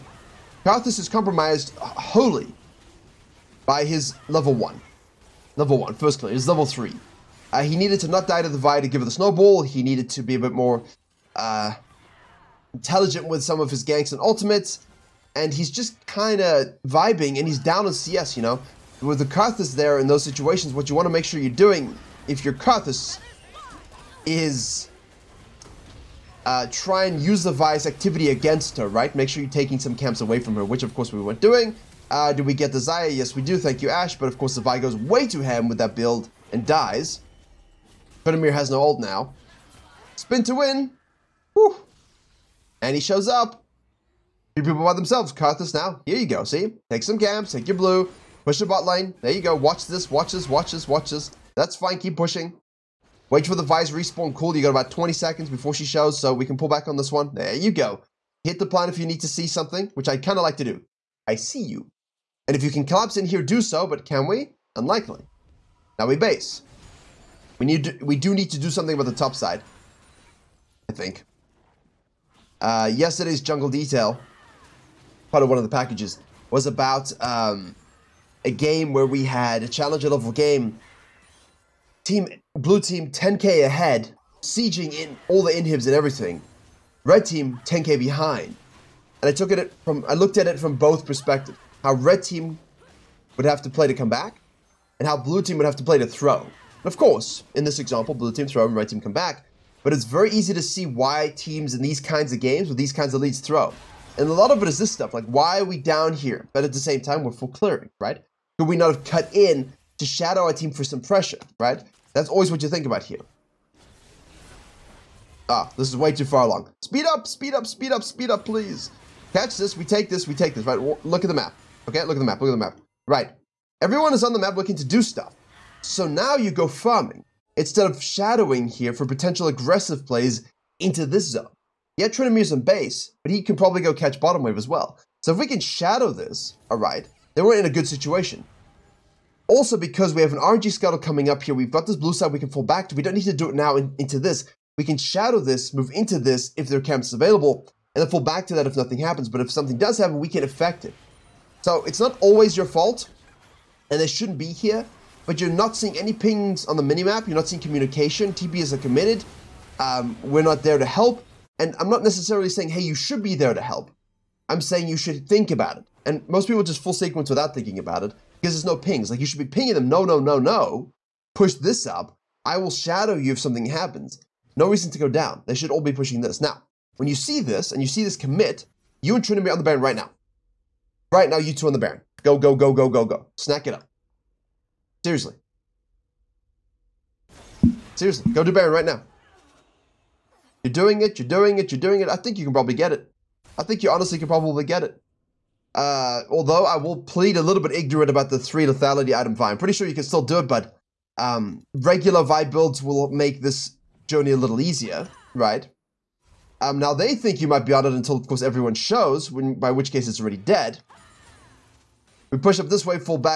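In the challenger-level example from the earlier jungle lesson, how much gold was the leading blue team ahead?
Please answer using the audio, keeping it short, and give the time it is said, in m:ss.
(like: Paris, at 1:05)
10k, at 1:23.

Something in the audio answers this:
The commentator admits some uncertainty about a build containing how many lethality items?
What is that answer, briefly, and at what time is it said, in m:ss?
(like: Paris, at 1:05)
3, at 3:18.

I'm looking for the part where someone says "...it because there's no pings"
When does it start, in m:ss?
2:48.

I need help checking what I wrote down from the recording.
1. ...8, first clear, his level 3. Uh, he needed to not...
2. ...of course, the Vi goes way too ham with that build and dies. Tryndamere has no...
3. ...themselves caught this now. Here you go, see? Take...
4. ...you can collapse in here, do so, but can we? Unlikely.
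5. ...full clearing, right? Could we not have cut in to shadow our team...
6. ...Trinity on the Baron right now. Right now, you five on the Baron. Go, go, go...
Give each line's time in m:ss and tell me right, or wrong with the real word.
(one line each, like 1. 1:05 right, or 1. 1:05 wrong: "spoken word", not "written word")
1. 0:05 wrong: "1", not "8"
2. 0:34 right
3. 0:44 right
4. 1:02 right
5. 1:47 right
6. 2:59 wrong: "two", not "five".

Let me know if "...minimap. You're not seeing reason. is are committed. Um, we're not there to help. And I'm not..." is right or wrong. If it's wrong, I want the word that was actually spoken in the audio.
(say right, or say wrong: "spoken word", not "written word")
wrong: "communication", not "reason".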